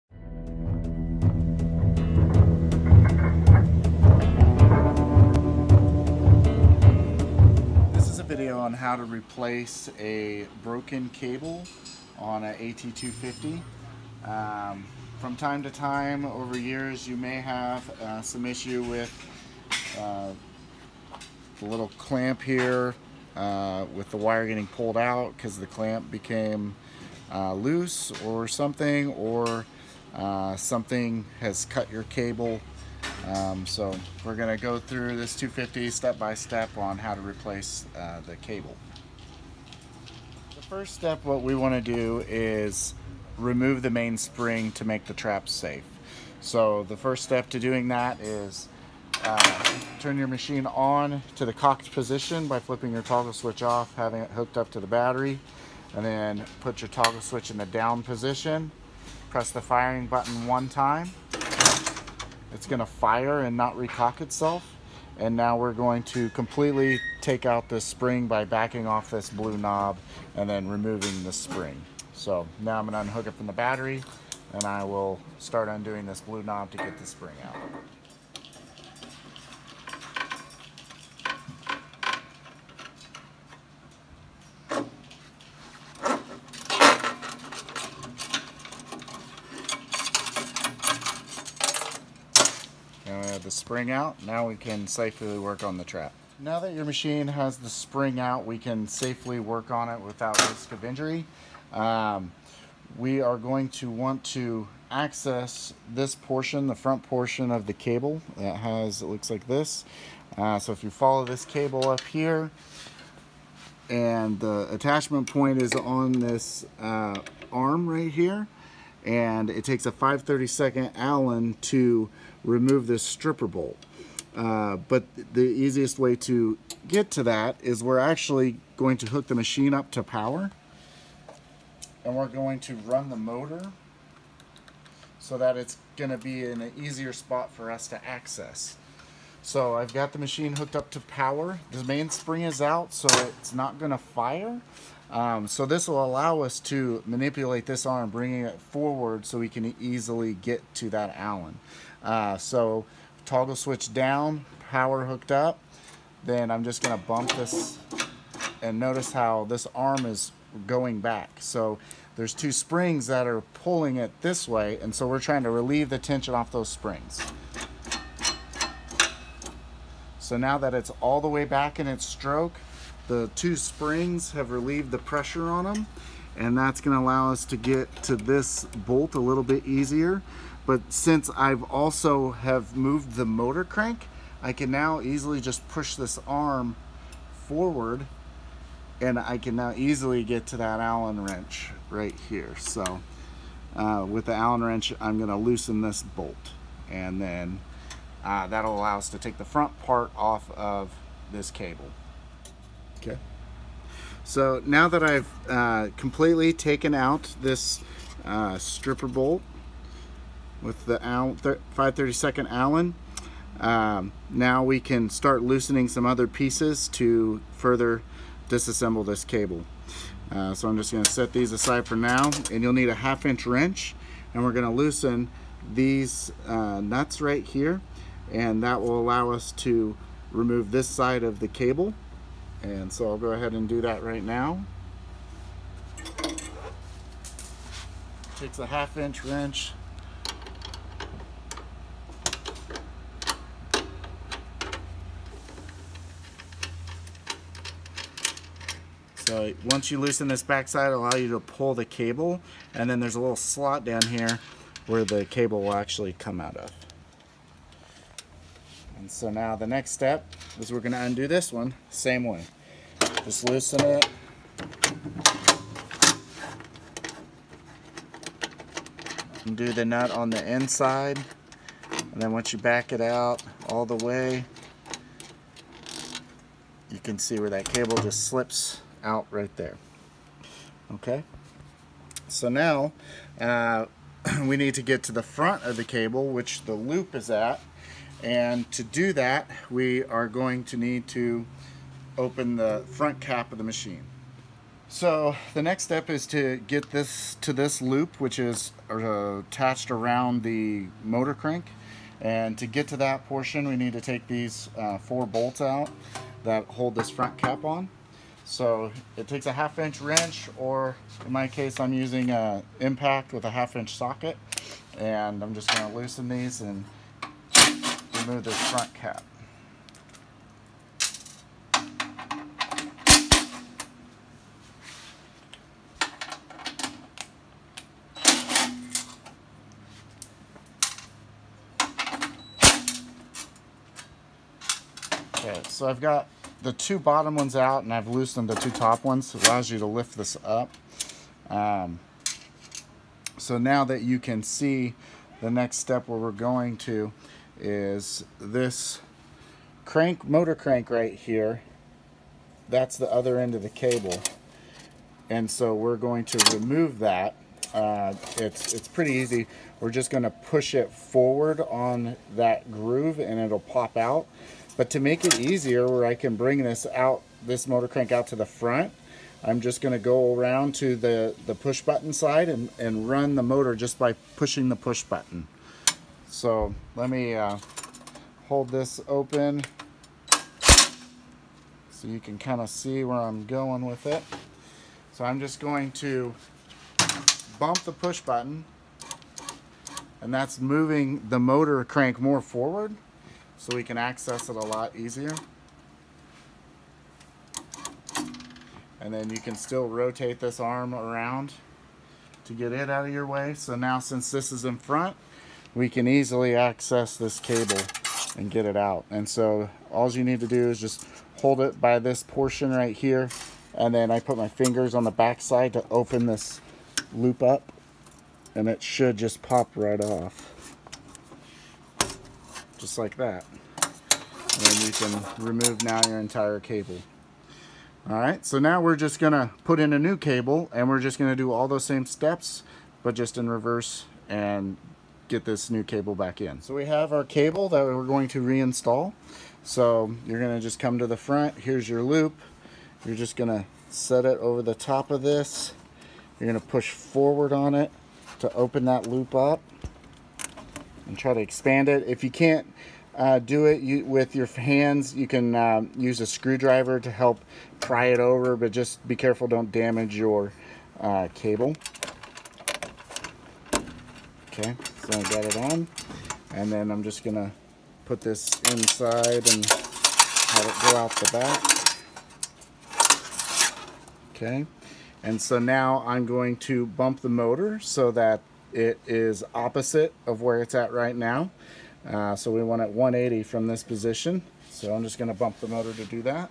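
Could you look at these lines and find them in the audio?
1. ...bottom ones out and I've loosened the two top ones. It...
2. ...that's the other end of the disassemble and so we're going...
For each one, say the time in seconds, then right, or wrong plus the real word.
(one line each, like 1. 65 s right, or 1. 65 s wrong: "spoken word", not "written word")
1. 336 s right
2. 352 s wrong: "cable", not "disassemble".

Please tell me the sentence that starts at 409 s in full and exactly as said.
And so all you need to do is just hold it by this portion right here.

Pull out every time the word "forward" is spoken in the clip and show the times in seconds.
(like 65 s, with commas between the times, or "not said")
148 s, 187 s, 360 s, 392 s, 446 s.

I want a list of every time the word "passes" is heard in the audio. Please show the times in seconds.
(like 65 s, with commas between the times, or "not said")
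not said.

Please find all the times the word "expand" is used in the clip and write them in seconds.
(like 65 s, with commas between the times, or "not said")
451 s.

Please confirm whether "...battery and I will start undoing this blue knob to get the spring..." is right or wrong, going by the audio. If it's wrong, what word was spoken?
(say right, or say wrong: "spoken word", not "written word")
right.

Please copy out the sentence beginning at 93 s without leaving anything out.
Now uh, the spring out, now we can safely work on the trap.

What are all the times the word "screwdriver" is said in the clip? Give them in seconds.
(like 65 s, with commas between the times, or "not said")
456 s.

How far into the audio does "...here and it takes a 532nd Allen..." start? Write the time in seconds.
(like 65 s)
118 s.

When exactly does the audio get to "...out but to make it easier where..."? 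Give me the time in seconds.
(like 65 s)
363 s.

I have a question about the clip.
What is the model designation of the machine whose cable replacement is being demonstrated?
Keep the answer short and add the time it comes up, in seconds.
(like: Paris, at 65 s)
AT250, at 12 s.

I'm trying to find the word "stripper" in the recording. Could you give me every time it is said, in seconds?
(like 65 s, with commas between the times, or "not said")
123 s, 208 s.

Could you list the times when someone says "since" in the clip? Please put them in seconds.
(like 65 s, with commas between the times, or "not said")
180 s, 404 s.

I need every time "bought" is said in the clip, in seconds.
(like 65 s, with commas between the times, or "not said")
not said.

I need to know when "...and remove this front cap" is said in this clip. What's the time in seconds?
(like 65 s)
316 s.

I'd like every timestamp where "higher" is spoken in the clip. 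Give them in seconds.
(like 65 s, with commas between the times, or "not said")
not said.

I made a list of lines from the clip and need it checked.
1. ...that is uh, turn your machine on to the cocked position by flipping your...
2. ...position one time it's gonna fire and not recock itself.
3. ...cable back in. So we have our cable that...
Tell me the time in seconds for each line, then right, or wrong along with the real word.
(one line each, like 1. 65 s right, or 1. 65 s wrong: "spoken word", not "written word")
1. 47 s right
2. 60 s wrong: "button", not "position"
3. 435 s right.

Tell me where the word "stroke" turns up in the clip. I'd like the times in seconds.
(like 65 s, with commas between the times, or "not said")
172 s.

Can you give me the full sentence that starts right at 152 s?
Uh, so toggle switch down, power hooked up.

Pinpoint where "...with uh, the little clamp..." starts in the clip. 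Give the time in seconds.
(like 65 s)
18 s.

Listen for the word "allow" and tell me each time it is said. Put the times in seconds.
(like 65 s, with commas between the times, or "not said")
146 s, 176 s, 198 s, 228 s, 251 s, 339 s.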